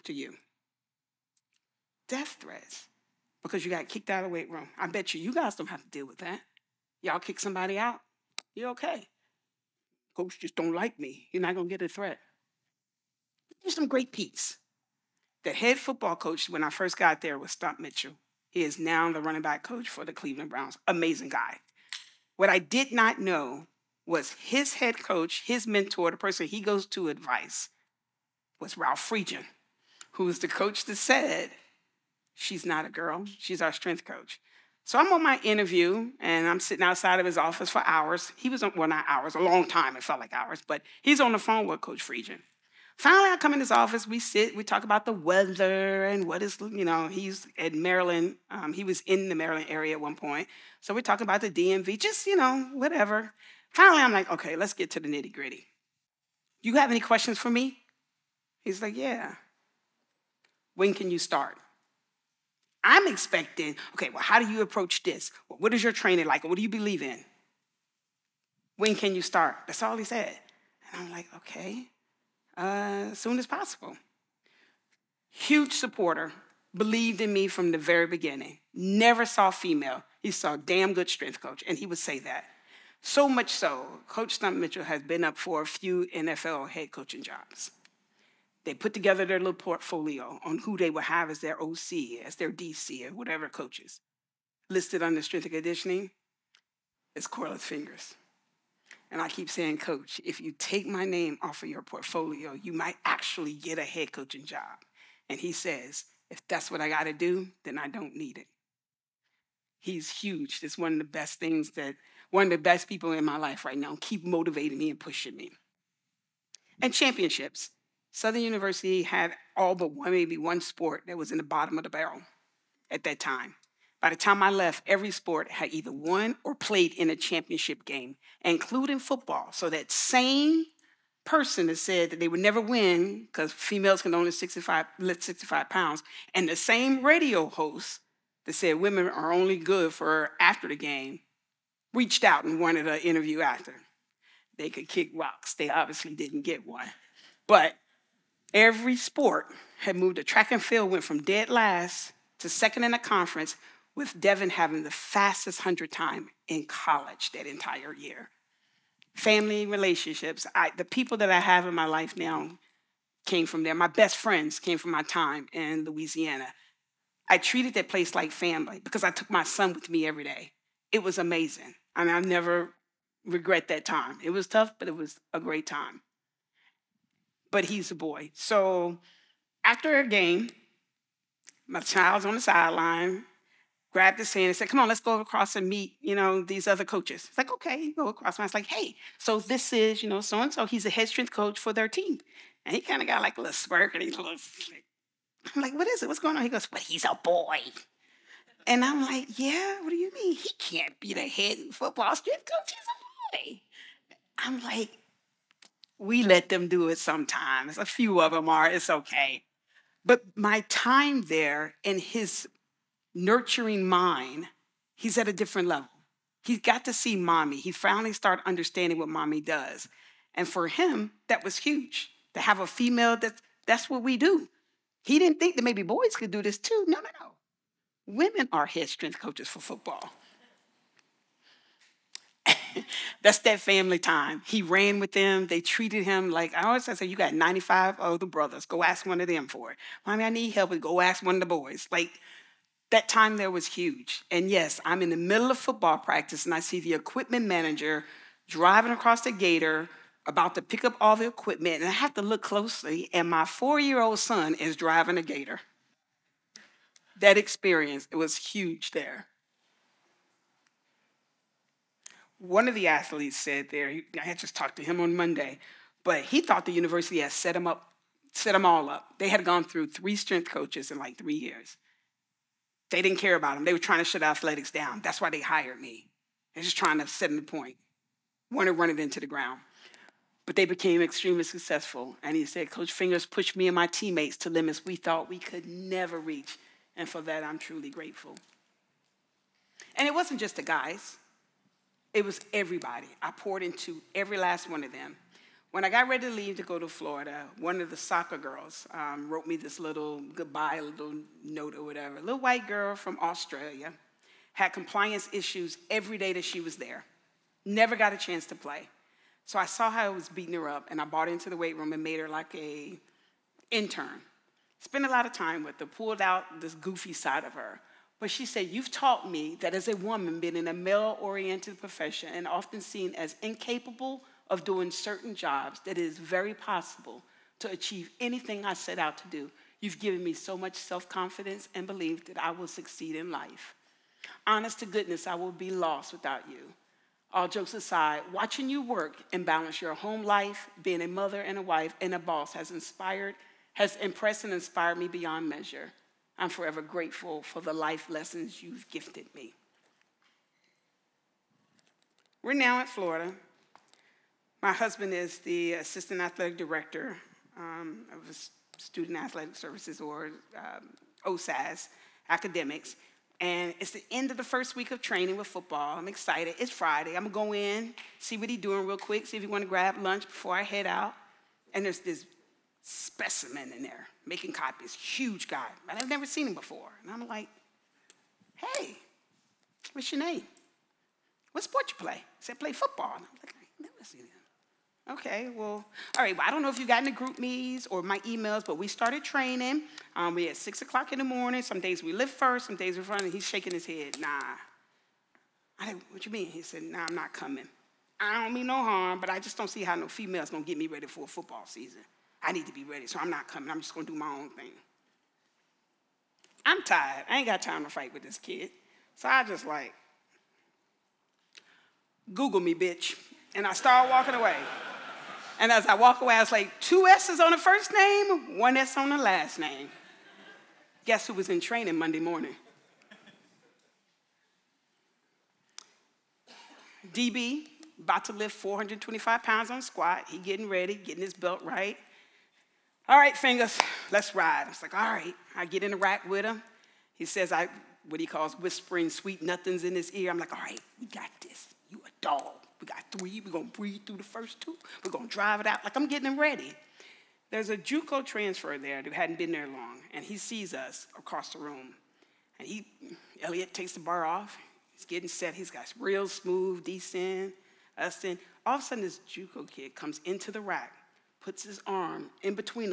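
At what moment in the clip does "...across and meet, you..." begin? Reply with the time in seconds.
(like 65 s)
185 s.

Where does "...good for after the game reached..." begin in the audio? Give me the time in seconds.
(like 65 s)
139 s.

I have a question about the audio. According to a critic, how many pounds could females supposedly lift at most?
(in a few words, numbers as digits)
65.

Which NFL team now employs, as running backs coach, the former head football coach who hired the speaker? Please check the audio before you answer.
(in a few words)
Cleveland Browns.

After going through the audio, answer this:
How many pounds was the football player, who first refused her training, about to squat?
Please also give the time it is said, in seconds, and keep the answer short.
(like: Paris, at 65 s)
425, at 428 s.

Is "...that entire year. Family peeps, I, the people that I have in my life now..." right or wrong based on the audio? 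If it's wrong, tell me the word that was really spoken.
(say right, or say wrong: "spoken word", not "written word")
wrong: "relationships", not "peeps".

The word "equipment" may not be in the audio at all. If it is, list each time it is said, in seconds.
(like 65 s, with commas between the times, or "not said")
246 s, 251 s.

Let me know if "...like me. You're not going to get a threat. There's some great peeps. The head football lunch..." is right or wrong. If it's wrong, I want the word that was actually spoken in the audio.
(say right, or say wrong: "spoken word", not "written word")
wrong: "coach", not "lunch".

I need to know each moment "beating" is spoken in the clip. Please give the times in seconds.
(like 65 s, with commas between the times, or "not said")
310 s.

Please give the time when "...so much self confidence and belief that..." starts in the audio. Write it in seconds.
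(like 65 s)
330 s.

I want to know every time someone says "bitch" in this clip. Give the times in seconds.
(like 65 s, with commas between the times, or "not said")
412 s.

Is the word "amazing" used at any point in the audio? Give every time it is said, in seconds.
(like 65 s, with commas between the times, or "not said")
20 s, 171 s.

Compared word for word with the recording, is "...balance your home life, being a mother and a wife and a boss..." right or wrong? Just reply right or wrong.
right.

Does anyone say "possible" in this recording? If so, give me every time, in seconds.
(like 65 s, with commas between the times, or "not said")
73 s, 326 s.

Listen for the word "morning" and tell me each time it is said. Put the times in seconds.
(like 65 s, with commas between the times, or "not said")
391 s, 422 s.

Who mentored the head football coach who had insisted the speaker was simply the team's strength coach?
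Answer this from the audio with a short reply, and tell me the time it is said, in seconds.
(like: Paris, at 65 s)
Ralph Friedgen, at 28 s.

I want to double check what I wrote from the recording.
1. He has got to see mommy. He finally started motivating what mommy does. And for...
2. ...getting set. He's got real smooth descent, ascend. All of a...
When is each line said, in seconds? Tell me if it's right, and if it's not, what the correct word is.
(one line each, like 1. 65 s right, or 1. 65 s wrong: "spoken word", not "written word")
1. 216 s wrong: "understanding", not "motivating"
2. 455 s right.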